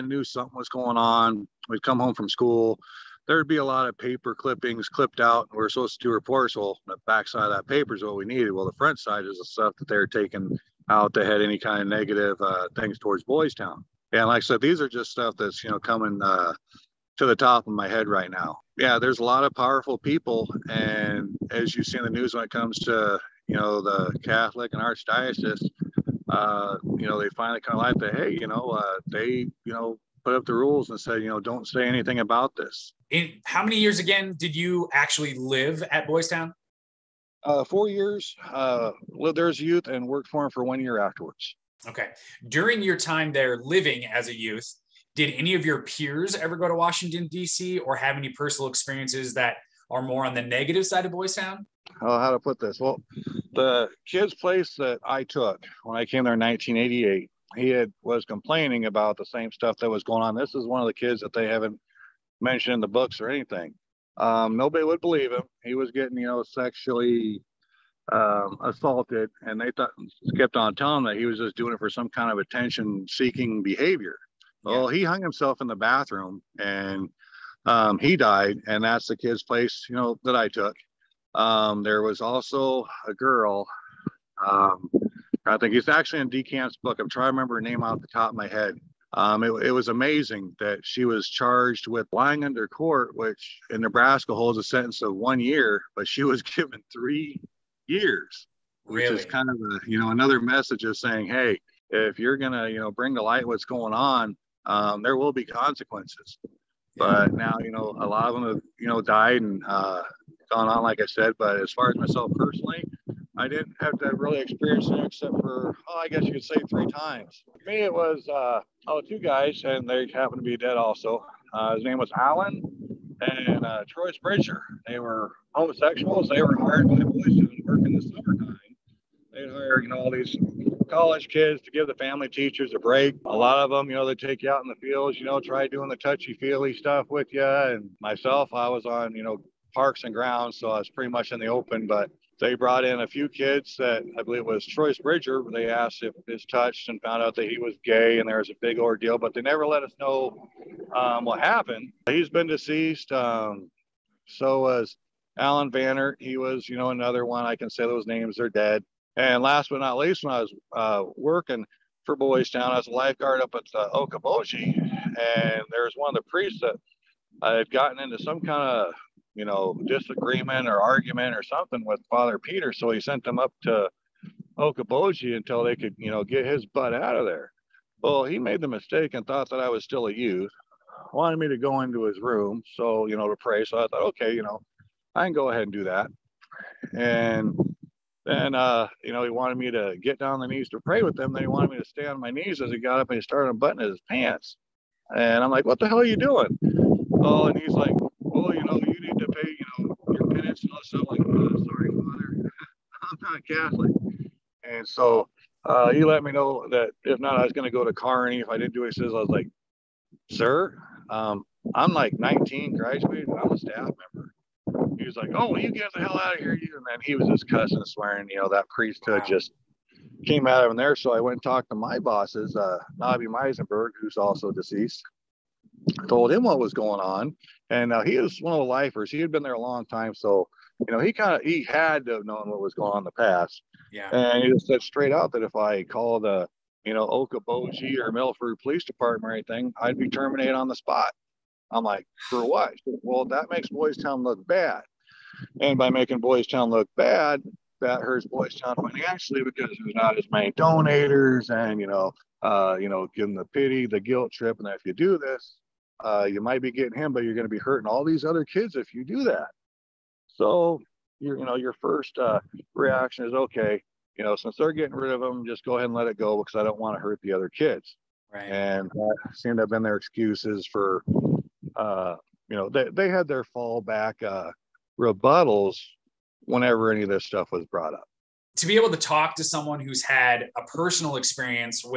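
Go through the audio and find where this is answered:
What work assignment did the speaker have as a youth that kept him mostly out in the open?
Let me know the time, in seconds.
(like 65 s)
139 s.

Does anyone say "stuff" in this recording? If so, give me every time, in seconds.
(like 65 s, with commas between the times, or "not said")
9 s, 15 s, 59 s, 136 s, 200 s, 277 s.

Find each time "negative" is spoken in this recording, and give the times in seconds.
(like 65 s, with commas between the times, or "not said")
11 s, 50 s.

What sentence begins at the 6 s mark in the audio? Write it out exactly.
Well, the backside of that paper is what we needed.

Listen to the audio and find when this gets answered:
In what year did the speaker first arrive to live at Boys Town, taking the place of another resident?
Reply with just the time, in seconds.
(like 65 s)
56 s.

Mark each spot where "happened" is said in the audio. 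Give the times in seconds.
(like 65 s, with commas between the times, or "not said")
120 s, 151 s.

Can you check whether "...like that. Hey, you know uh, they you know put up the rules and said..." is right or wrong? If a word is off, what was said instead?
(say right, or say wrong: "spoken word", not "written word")
right.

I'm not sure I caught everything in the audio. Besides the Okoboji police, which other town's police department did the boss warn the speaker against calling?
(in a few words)
Milford.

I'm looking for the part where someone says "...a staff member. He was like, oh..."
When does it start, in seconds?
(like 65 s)
213 s.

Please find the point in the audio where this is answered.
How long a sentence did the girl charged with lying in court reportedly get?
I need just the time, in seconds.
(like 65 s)
96 s.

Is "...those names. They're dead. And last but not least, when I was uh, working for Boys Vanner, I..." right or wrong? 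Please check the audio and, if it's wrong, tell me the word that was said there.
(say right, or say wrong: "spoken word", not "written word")
wrong: "Town", not "Vanner".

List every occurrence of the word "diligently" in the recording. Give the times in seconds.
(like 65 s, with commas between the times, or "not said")
not said.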